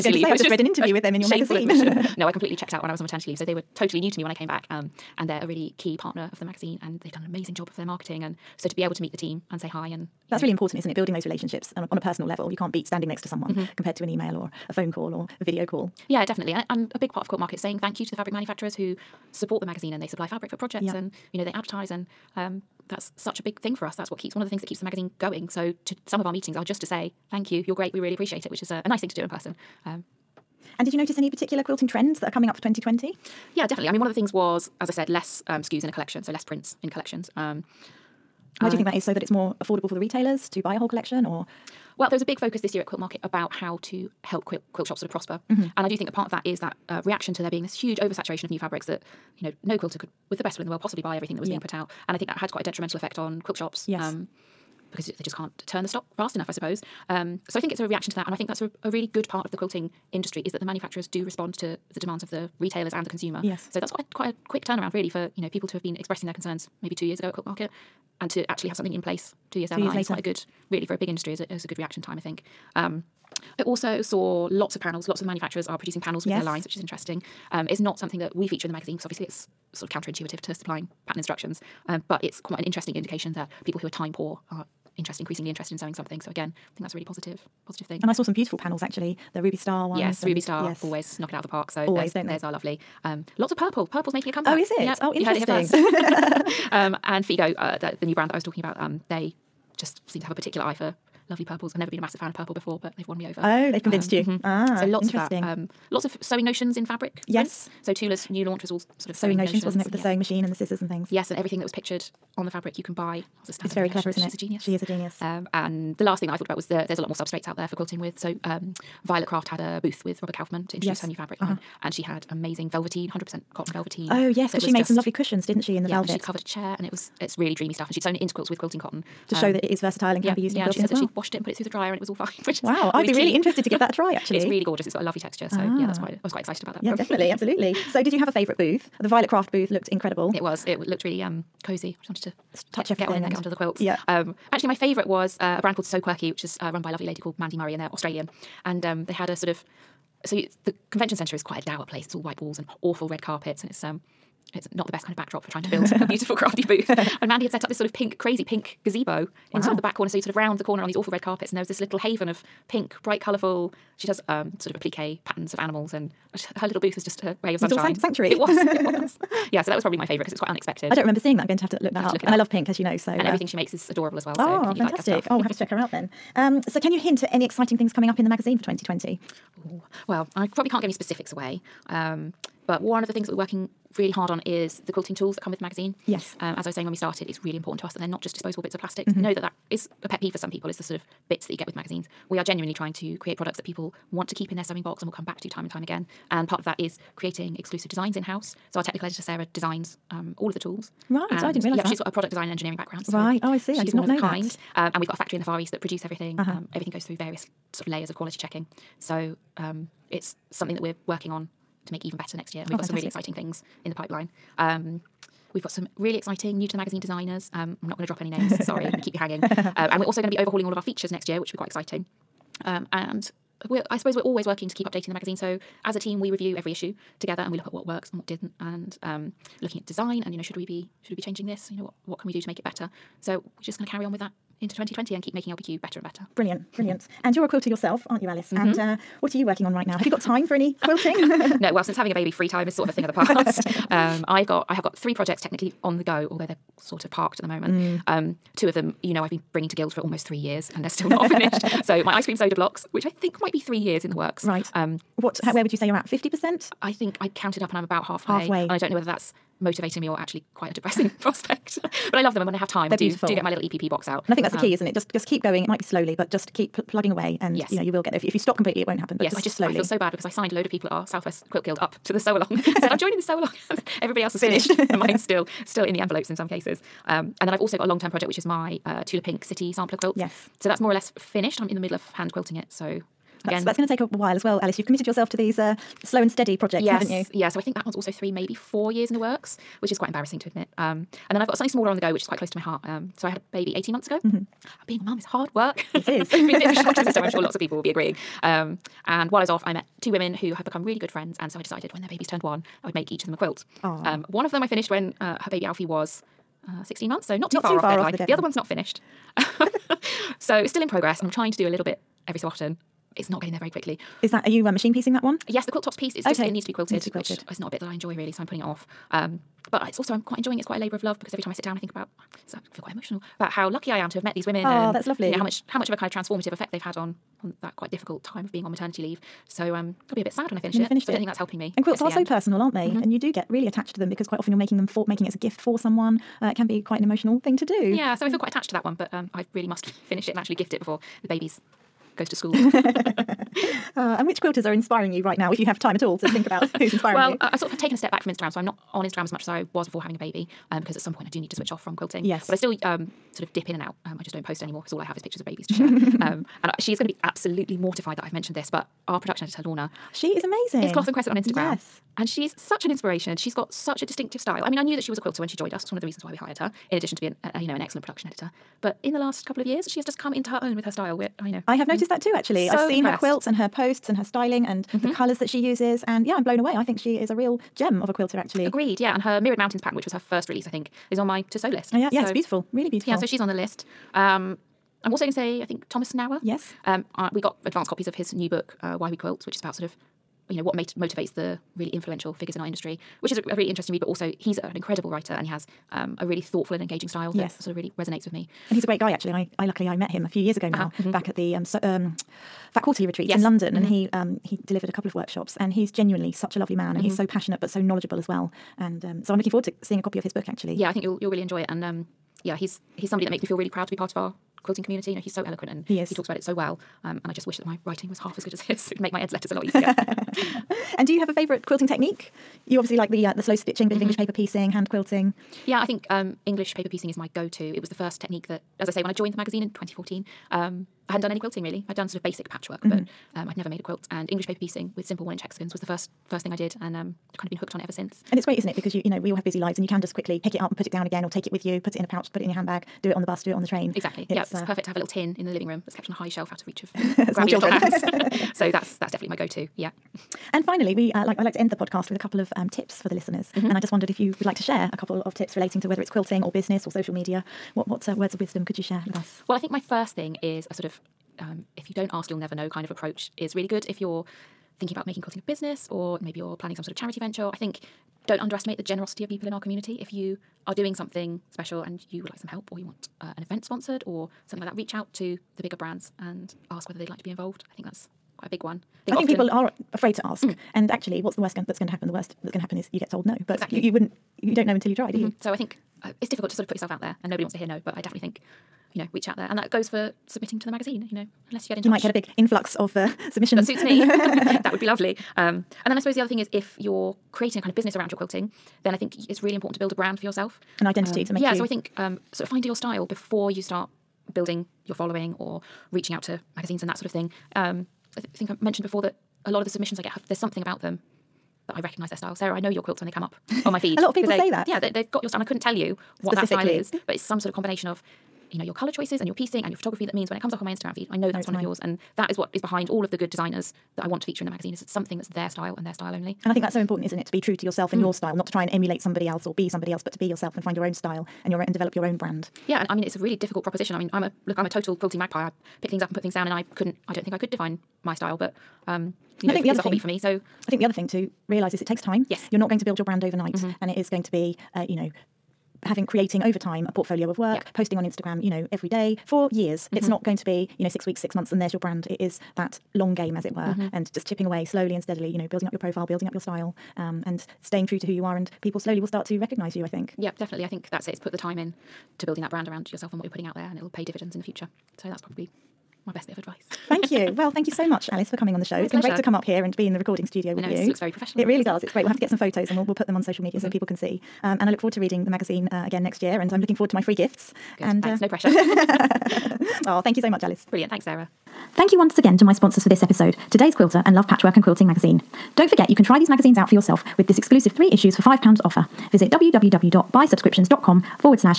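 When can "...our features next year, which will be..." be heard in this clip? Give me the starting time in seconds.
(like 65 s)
220 s.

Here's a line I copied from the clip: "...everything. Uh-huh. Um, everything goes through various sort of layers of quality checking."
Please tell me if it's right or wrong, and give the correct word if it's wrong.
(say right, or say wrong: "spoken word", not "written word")
right.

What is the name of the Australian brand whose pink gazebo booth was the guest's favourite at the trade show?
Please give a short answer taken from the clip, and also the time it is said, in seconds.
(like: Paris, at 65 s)
So Quirky, at 145 s.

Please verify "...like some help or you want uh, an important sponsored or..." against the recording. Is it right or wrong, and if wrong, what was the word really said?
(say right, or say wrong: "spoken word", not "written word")
wrong: "event", not "important".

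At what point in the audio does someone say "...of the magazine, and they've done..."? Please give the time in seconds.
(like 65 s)
6 s.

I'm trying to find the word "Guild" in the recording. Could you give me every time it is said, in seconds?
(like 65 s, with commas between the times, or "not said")
249 s, 271 s.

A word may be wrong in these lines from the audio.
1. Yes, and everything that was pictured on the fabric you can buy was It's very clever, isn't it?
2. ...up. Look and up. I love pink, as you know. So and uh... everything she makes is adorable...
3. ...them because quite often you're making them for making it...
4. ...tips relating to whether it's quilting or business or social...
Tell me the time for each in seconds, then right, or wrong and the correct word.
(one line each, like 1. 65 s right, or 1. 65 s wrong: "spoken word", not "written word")
1. 111 s right
2. 172 s right
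3. 333 s right
4. 455 s right.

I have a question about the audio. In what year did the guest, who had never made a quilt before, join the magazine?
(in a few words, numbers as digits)
2014.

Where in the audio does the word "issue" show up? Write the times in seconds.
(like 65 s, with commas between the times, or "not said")
226 s, 587 s.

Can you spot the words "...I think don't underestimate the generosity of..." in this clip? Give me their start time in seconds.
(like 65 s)
467 s.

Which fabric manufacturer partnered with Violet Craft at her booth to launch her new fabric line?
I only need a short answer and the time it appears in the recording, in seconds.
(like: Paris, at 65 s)
Robert Kaufman, at 120 s.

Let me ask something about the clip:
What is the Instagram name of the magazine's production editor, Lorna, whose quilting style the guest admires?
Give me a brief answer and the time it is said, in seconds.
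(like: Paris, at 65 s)
Cloth and Crescent, at 360 s.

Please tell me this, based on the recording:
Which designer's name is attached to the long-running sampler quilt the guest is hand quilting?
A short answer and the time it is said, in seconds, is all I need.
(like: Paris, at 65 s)
Tula Pink, at 279 s.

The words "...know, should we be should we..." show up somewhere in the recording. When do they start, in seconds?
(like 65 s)
230 s.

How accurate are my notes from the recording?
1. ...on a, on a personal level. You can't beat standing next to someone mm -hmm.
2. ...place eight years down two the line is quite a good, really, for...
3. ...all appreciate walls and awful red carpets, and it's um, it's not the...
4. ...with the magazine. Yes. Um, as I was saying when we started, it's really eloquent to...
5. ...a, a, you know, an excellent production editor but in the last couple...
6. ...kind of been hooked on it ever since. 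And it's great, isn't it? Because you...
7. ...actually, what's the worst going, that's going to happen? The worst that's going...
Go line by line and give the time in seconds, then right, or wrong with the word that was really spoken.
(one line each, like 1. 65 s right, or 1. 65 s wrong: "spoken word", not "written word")
1. 11 s right
2. 69 s wrong: "two", not "eight"
3. 152 s wrong: "white", not "appreciate"
4. 185 s wrong: "important", not "eloquent"
5. 367 s right
6. 437 s right
7. 480 s right.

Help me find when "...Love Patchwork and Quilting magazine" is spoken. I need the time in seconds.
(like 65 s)
584 s.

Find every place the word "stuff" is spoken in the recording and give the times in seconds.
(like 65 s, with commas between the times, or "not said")
127 s, 175 s.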